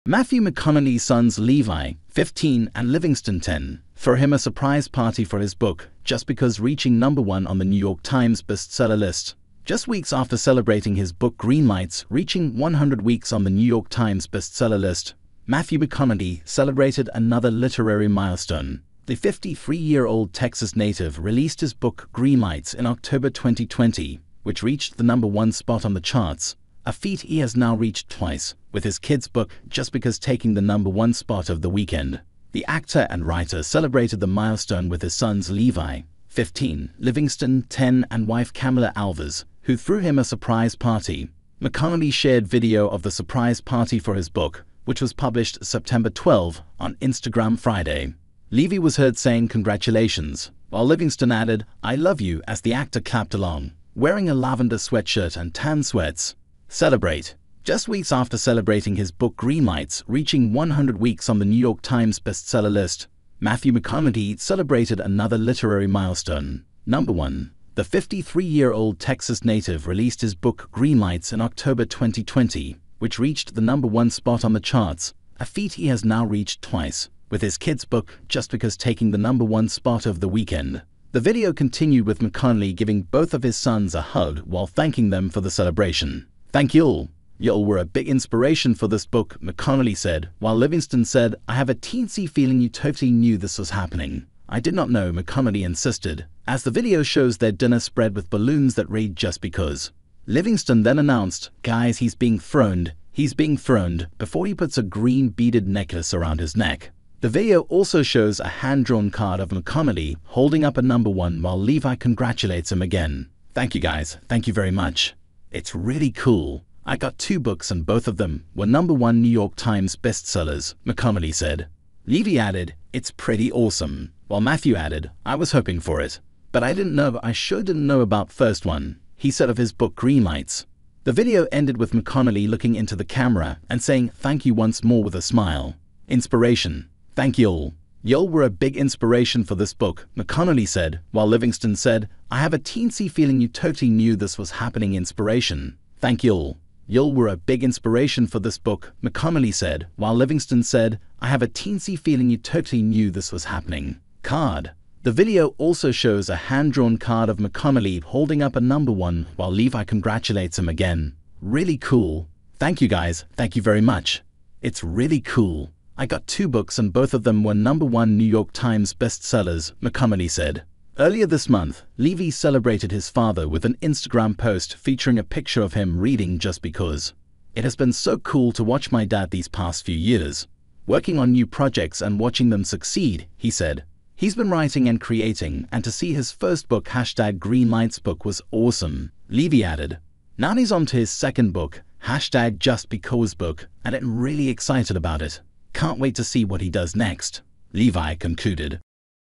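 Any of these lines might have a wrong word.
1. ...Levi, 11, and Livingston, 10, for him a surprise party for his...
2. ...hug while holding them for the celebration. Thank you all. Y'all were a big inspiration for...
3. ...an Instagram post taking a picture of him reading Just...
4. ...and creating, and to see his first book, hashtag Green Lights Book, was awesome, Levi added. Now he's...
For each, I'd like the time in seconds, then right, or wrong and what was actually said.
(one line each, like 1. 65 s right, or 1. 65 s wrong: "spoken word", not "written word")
1. 1 s wrong: "15", not "11"
2. 84 s wrong: "thanking", not "holding"
3. 173 s wrong: "featuring", not "taking"
4. 184 s right.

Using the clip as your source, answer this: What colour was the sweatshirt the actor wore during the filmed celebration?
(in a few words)
Lavender.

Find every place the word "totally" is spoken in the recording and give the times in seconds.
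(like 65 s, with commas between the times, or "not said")
92 s, 143 s, 152 s.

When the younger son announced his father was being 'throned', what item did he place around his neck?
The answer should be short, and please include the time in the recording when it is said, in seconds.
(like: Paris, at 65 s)
Green beaded necklace, at 104 s.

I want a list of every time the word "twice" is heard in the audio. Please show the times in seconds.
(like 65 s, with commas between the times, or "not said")
28 s, 76 s.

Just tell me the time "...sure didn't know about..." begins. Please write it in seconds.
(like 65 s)
127 s.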